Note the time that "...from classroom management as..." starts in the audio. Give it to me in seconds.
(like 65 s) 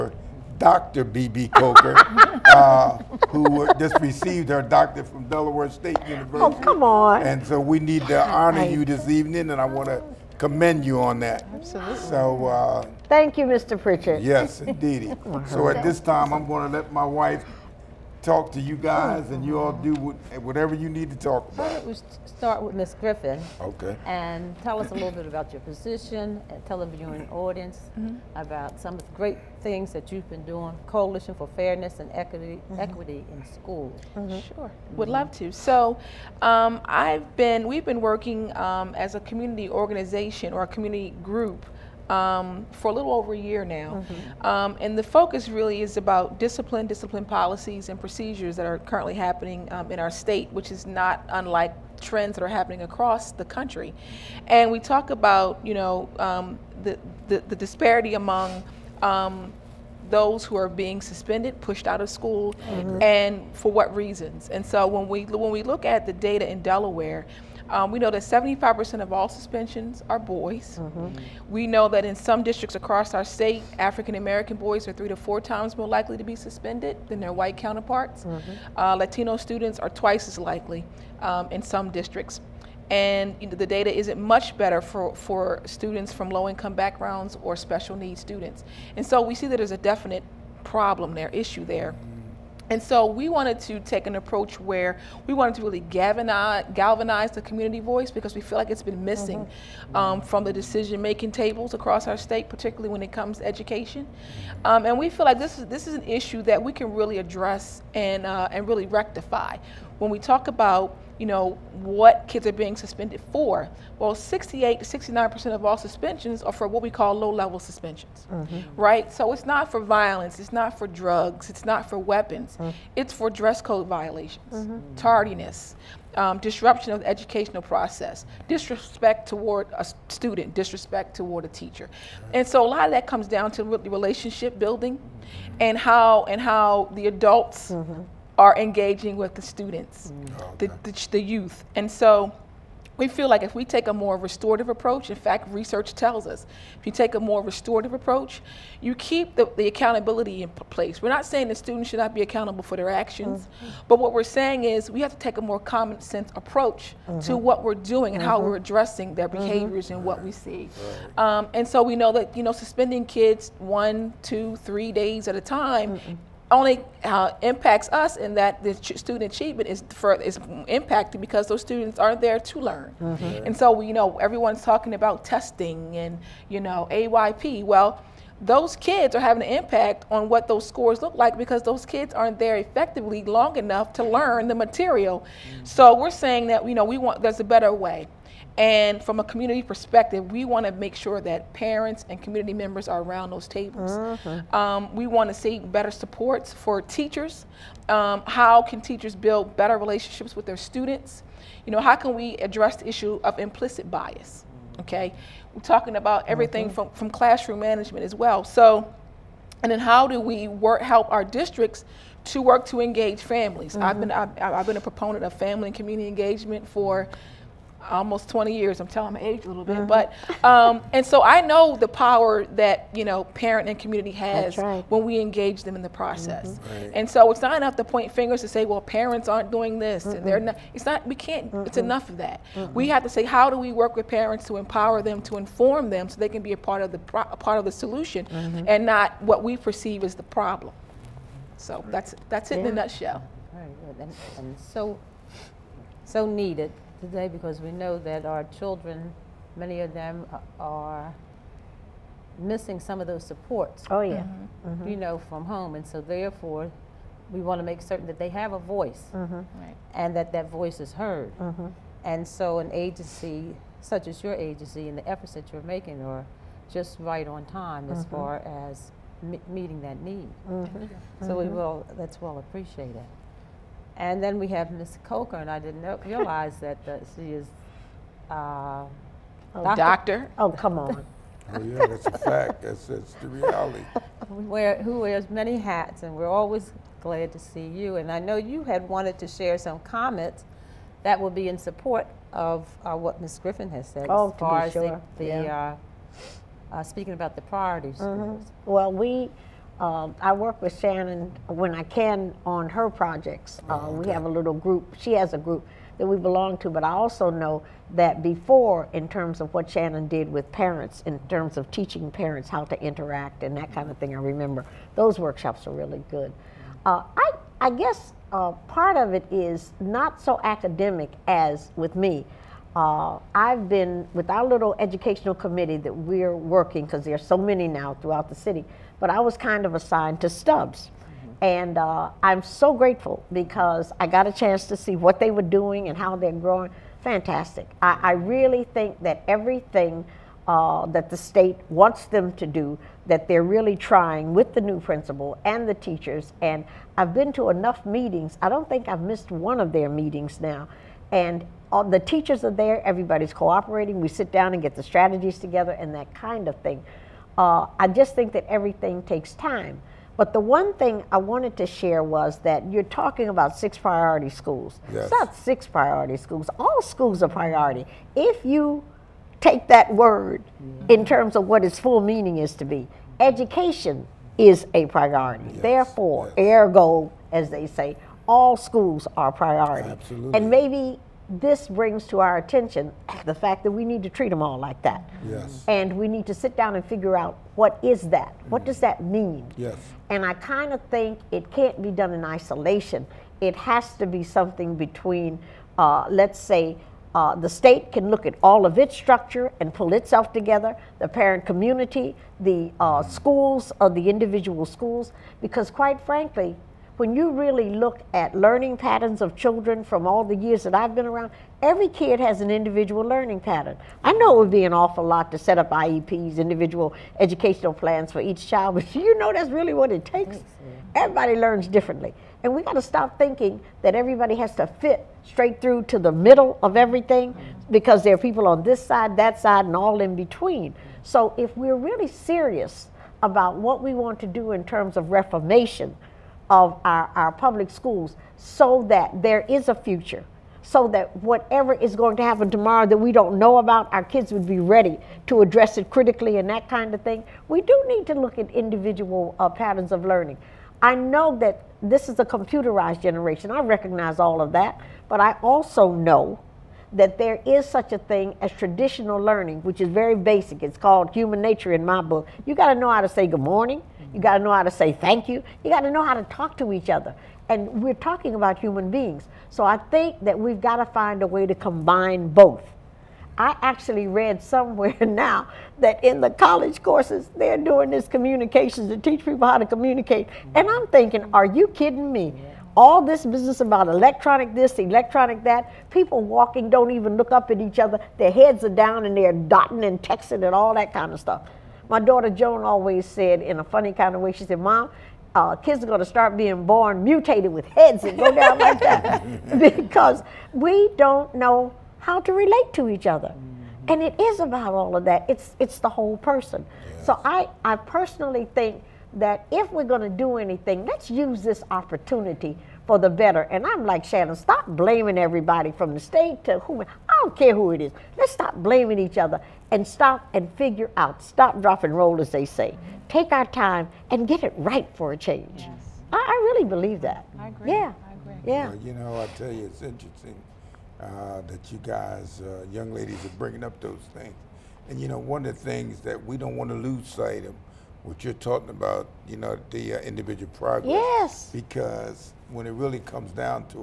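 206 s.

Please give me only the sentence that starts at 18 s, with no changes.
guys, and you all do whatever you need to talk about.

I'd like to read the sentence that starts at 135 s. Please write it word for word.
and how and how the adults mm-hmm are engaging with the students, mm.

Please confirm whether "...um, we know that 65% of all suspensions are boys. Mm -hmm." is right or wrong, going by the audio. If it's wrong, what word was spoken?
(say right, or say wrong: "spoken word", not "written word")
wrong: "75", not "65".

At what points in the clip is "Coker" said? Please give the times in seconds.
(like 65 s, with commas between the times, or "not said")
1 s, 275 s.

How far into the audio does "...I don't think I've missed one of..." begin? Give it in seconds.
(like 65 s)
348 s.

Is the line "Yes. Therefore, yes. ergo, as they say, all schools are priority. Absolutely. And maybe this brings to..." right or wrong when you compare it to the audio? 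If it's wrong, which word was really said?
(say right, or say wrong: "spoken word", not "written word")
right.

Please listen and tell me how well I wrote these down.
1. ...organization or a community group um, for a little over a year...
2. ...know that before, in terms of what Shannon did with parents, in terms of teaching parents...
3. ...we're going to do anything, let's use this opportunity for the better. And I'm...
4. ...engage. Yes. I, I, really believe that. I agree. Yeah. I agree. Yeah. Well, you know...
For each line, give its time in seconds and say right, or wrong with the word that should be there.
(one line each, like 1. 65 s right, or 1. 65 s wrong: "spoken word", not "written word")
1. 39 s right
2. 307 s right
3. 509 s right
4. 525 s wrong: "change", not "engage".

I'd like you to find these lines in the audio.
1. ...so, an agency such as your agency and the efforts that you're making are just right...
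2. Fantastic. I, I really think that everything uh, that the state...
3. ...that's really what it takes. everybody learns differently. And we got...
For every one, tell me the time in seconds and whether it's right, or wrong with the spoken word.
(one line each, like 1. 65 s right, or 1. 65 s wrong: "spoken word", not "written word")
1. 262 s right
2. 337 s right
3. 419 s right.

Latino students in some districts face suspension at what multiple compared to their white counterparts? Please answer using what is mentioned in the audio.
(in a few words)
Twice.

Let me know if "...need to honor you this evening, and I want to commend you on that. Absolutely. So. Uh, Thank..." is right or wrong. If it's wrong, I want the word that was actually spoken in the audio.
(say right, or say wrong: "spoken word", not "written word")
right.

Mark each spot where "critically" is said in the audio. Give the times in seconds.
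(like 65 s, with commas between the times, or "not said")
445 s.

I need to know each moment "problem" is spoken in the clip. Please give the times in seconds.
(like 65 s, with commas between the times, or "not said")
90 s, 240 s.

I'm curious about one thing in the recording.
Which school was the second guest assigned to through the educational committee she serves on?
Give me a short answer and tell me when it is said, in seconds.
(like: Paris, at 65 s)
Stubbs, at 330 s.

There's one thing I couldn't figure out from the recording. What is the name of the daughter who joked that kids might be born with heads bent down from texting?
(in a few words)
Joan.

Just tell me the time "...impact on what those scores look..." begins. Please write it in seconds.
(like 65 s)
179 s.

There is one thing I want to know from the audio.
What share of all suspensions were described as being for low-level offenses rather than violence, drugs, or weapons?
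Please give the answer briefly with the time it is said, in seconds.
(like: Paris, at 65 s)
68 to 69%, at 114 s.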